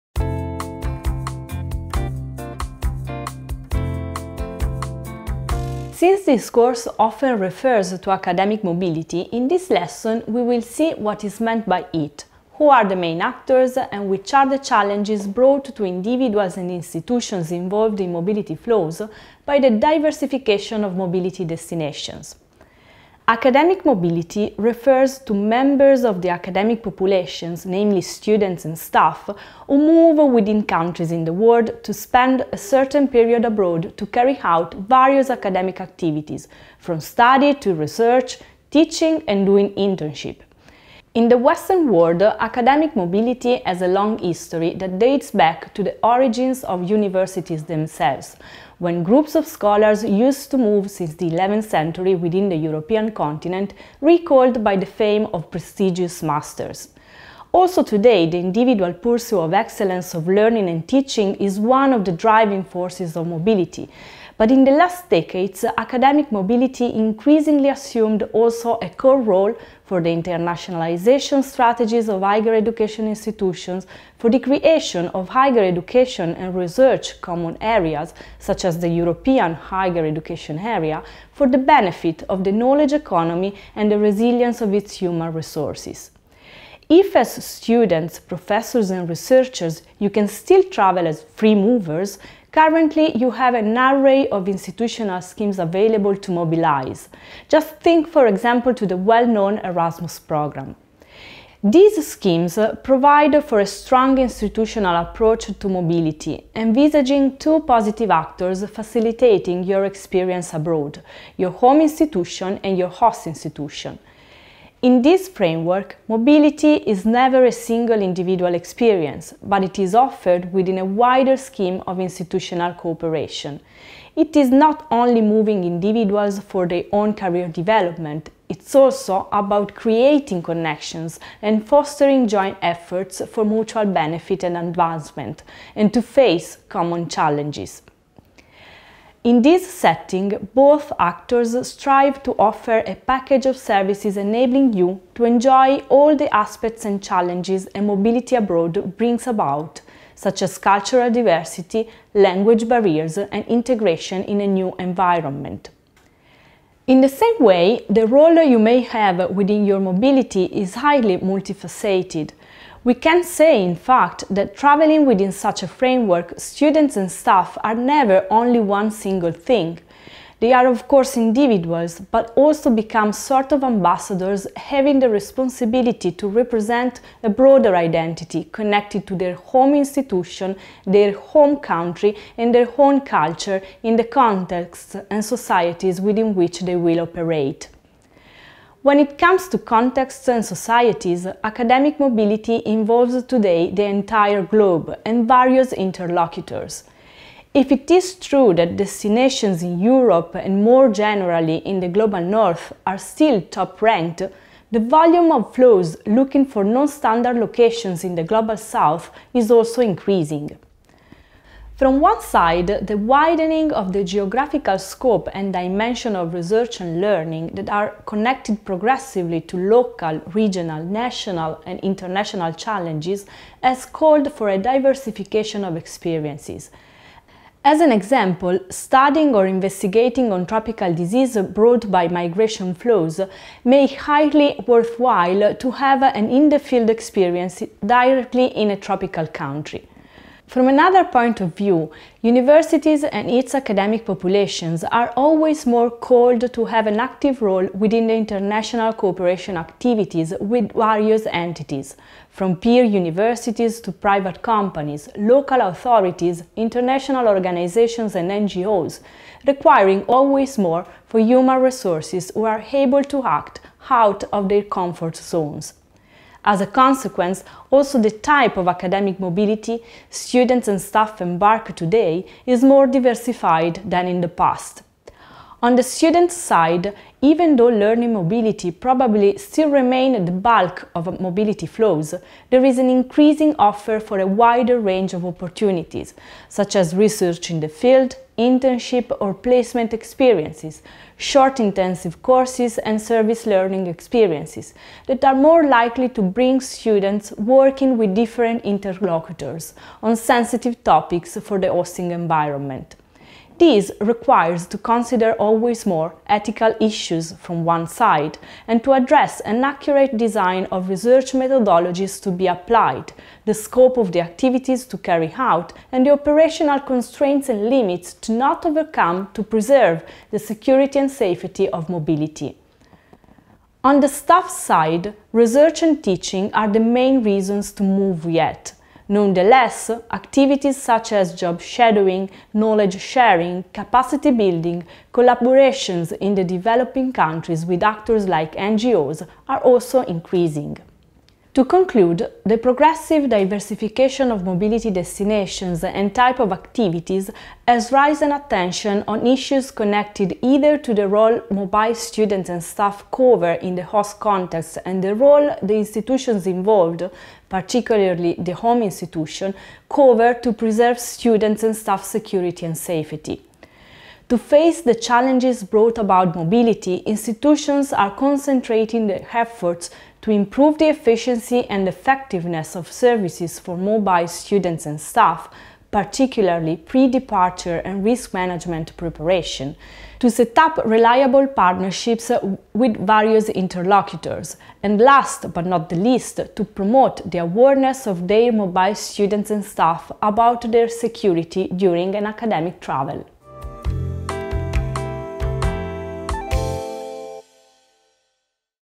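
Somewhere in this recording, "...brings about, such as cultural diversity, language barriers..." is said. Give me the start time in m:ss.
2:28.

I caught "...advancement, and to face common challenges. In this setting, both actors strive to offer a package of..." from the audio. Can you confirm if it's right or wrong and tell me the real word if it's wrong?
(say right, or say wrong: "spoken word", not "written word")
right.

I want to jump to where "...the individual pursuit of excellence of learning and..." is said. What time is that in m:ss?
0:58.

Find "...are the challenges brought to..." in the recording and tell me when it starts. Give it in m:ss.
0:14.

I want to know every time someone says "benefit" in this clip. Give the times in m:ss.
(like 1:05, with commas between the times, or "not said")
1:21, 2:13.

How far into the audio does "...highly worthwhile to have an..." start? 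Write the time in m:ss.
3:53.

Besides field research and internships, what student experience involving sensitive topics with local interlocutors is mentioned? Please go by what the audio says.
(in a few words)
service learning.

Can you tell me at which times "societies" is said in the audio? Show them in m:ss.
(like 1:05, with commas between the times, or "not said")
3:05, 3:10.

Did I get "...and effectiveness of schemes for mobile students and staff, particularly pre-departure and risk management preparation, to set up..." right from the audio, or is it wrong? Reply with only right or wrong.
wrong.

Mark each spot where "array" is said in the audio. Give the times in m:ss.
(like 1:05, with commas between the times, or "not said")
1:33.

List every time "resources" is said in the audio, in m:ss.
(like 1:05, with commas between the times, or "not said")
1:25, 4:21.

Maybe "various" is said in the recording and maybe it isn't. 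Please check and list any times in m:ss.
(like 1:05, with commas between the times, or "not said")
0:34, 3:15, 4:10, 6:23.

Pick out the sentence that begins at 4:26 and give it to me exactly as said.
As a consequence, also the type of academic mobility students and staff embark today is more diversified than in the past.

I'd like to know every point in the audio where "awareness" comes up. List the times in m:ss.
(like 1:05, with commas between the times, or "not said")
6:27.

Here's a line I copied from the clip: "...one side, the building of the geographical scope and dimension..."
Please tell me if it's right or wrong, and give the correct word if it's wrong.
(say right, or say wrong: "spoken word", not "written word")
wrong: "widening", not "building".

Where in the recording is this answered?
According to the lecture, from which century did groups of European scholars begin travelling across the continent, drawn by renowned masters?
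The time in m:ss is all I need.
0:51.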